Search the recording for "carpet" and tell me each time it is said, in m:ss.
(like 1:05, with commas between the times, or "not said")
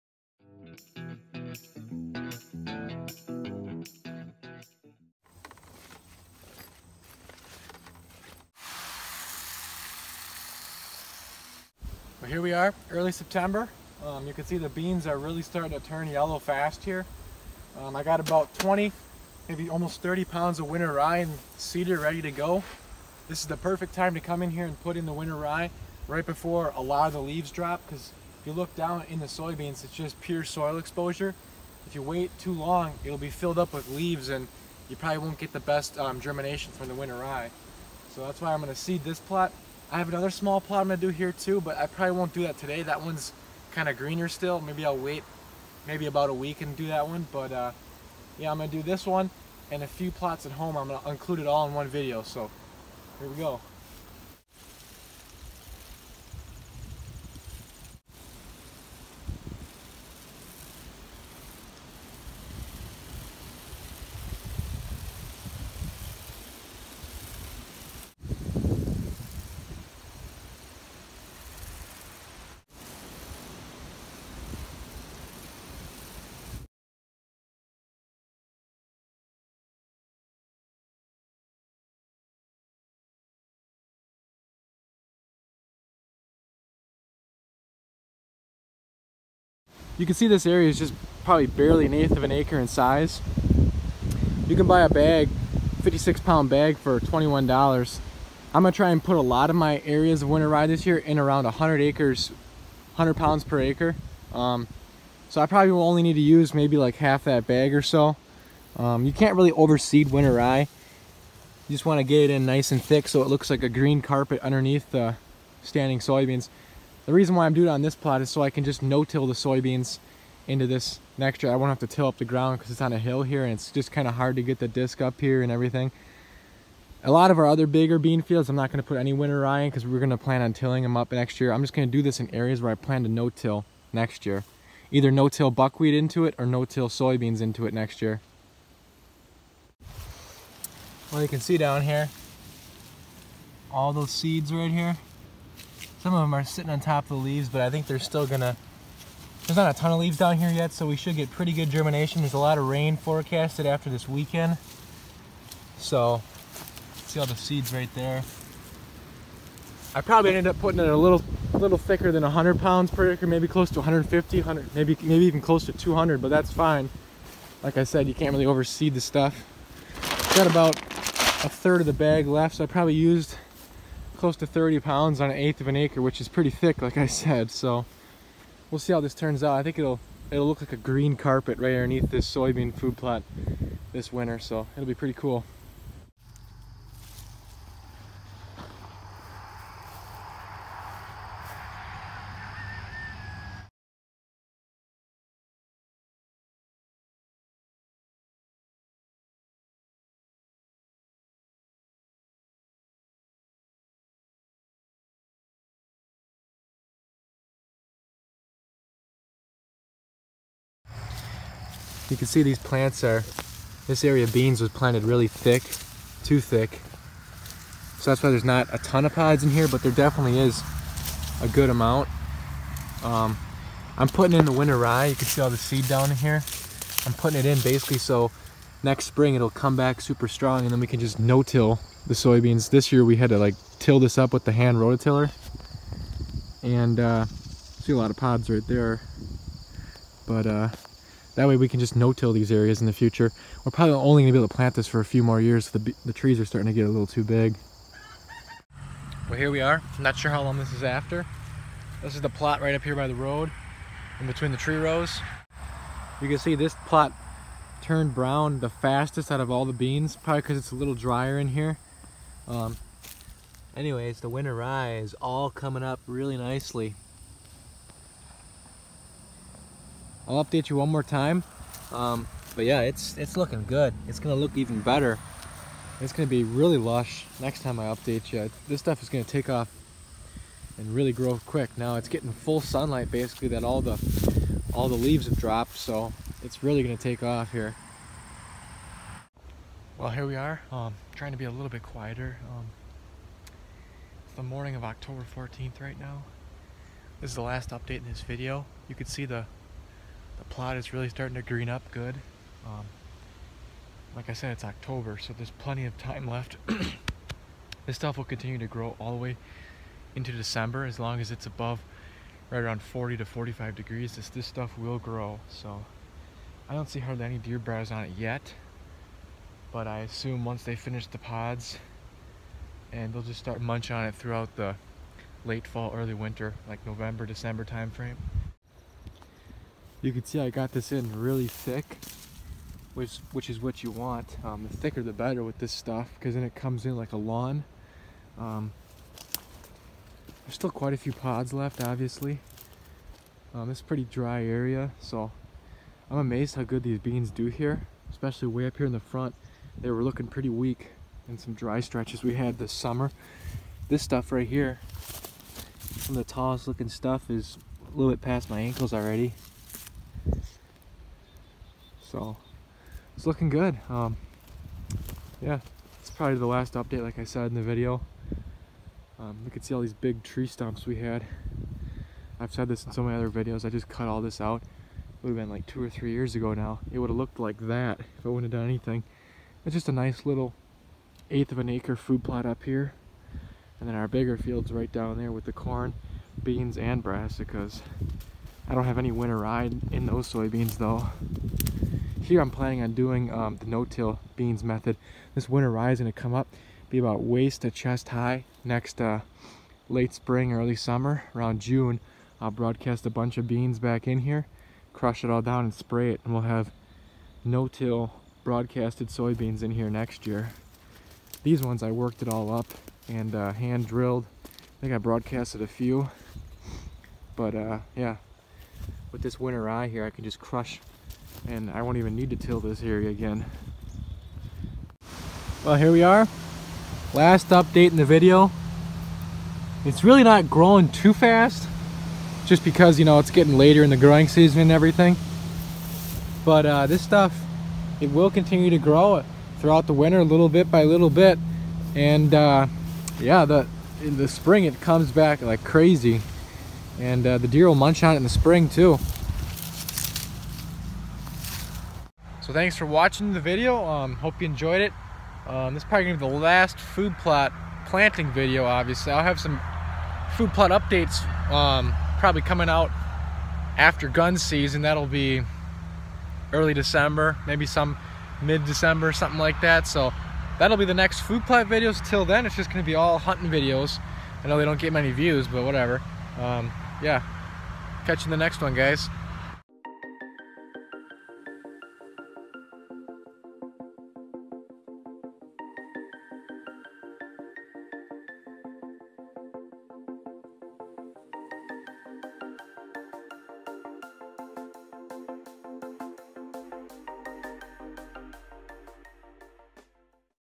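1:54, 3:01.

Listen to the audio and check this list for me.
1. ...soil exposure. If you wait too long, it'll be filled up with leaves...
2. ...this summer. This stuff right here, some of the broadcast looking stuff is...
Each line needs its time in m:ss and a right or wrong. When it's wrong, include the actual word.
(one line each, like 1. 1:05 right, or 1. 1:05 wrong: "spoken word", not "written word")
1. 0:30 right
2. 5:52 wrong: "tallest", not "broadcast".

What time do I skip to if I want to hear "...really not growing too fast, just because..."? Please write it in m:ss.
7:10.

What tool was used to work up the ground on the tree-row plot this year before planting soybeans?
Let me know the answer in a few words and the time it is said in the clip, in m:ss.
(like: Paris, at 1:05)
hand rototiller, at 3:54.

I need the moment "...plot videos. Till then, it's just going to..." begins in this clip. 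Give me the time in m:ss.
7:51.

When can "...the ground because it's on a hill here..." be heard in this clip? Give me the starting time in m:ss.
2:02.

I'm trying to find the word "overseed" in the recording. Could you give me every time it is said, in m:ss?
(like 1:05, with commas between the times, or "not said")
1:49, 2:48.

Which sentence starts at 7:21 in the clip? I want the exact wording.
And uh, yeah, the, in the spring, it comes back like crazy.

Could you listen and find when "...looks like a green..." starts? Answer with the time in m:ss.
1:53.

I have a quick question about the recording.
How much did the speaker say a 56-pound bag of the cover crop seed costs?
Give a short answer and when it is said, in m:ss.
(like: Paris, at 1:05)
$21, at 1:36.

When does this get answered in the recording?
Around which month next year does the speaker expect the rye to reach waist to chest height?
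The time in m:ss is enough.
6:41.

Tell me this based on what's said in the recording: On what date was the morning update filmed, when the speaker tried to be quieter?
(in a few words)
October 14th.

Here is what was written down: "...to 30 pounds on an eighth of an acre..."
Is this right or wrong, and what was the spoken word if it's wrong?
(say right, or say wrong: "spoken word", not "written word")
right.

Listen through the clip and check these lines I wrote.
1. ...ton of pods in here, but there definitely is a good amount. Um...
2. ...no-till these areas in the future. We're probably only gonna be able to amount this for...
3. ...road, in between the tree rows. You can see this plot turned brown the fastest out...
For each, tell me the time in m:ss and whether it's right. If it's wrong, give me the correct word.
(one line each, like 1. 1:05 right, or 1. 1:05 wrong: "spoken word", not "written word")
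1. 3:38 right
2. 4:01 wrong: "plant", not "amount"
3. 4:13 right.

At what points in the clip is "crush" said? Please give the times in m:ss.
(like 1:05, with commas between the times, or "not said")
6:44, 7:00.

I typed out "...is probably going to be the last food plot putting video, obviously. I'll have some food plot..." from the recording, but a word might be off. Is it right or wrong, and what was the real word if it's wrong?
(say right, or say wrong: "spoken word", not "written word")
wrong: "planting", not "putting".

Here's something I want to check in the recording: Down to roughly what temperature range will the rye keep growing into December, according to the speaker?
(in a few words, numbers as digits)
40 to 45 degrees.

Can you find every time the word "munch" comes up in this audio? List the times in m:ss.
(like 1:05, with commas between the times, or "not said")
5:23, 7:27.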